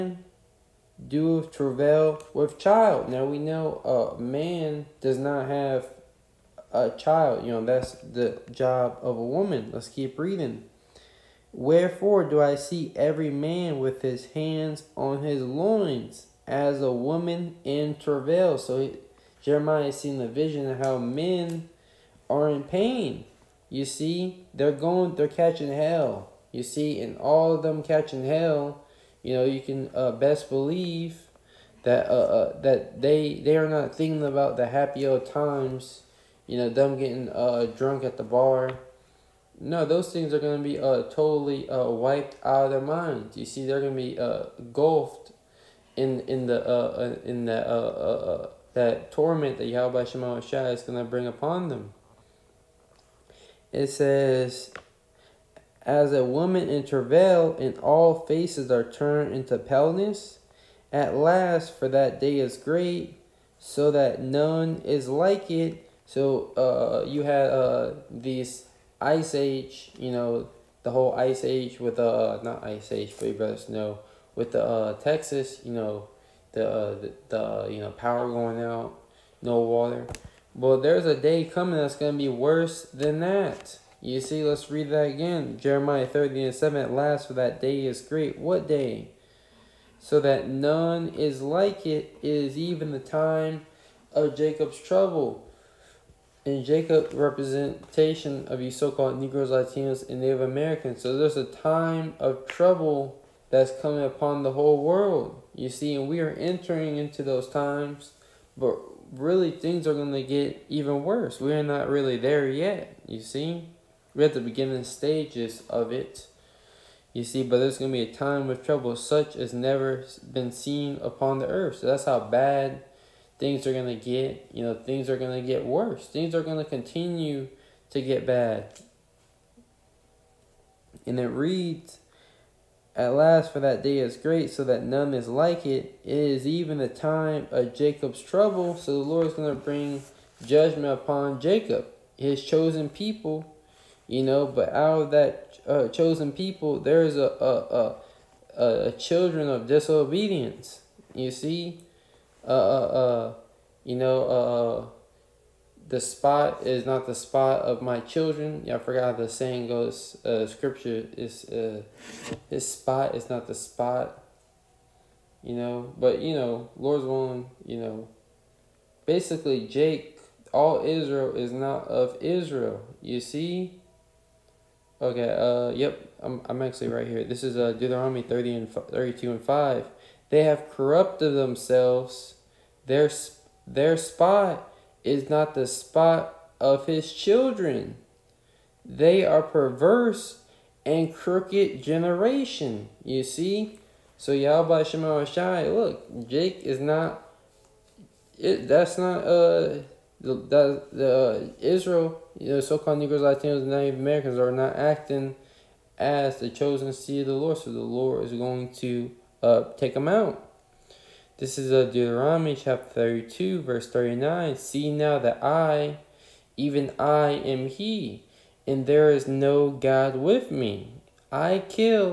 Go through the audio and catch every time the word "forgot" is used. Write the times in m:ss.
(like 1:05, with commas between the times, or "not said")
2:38.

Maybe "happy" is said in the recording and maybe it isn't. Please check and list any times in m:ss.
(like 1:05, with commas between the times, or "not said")
0:34.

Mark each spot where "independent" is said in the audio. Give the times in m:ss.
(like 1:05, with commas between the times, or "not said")
not said.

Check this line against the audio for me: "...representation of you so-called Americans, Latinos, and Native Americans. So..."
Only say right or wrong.
wrong.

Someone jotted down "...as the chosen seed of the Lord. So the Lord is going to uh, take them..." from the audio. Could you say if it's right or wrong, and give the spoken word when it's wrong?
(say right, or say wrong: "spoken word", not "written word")
right.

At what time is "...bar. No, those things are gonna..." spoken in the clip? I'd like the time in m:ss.
0:38.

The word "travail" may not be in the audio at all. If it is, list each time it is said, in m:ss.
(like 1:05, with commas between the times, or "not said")
0:01, 0:17, 0:56.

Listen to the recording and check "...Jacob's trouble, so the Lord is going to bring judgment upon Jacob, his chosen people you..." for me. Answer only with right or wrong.
right.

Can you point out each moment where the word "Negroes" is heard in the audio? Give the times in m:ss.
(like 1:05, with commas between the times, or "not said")
1:39, 3:22.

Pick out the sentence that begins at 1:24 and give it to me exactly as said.
You see, let's read that again.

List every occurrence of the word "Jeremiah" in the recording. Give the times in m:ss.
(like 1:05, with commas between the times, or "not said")
0:19, 1:25.